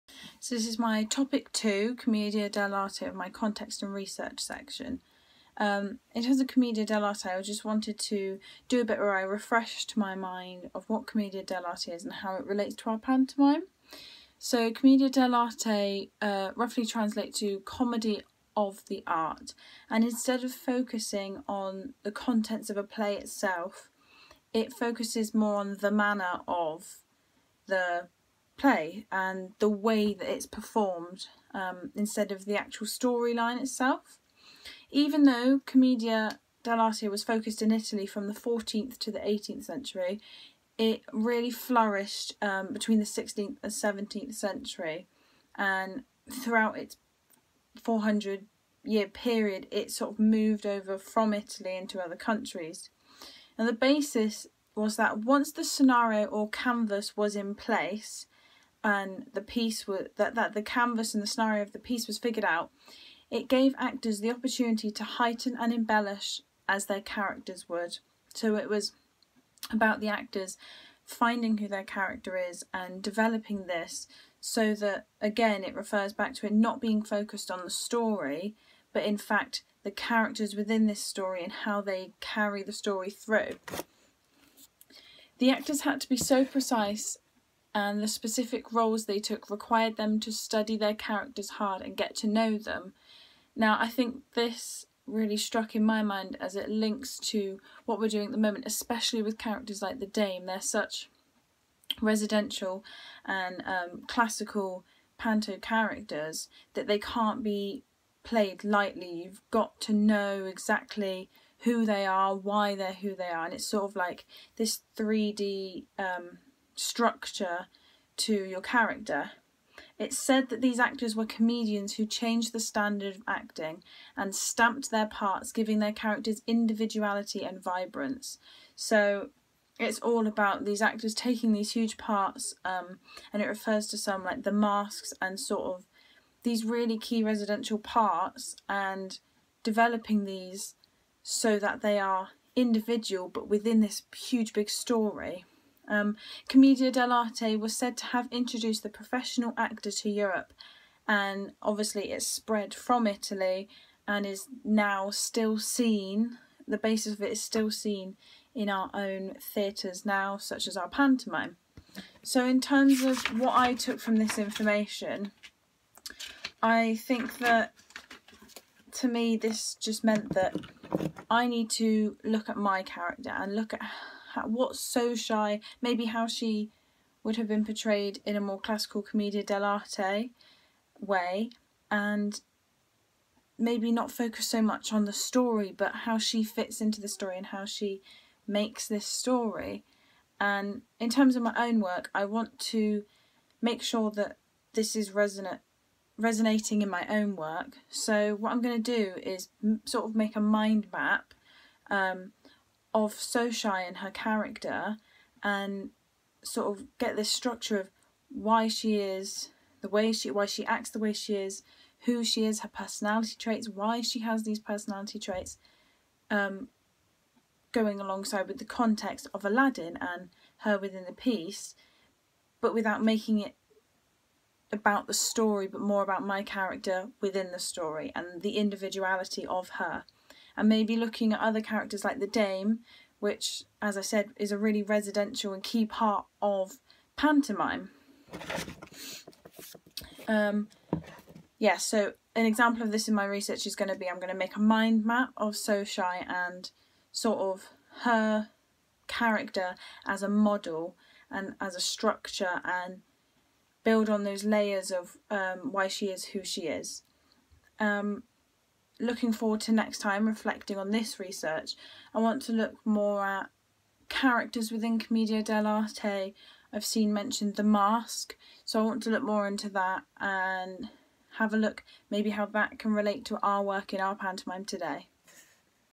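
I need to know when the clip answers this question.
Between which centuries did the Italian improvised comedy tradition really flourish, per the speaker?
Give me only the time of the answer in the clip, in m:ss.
0:42.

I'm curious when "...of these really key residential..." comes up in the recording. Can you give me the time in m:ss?
2:15.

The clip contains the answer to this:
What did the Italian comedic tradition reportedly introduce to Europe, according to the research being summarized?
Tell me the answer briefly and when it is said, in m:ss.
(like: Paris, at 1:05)
The professional actor, at 2:28.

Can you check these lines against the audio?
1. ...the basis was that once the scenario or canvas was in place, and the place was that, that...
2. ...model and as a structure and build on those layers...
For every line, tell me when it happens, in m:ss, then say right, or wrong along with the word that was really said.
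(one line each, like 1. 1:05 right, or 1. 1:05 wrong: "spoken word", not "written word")
1. 0:53 wrong: "piece", not "place"
2. 4:10 right.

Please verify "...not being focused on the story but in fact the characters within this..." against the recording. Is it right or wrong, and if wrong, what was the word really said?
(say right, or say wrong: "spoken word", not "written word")
right.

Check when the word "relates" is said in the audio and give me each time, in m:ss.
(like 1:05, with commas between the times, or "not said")
0:12, 4:32.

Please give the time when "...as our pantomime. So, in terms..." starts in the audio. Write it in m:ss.
2:40.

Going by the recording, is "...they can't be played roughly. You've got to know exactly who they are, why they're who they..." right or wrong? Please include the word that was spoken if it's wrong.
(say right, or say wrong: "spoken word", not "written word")
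wrong: "lightly", not "roughly".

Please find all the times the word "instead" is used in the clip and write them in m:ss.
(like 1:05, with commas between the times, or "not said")
0:20, 0:31.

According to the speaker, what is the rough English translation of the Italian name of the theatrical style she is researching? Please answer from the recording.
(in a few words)
Comedy of the art.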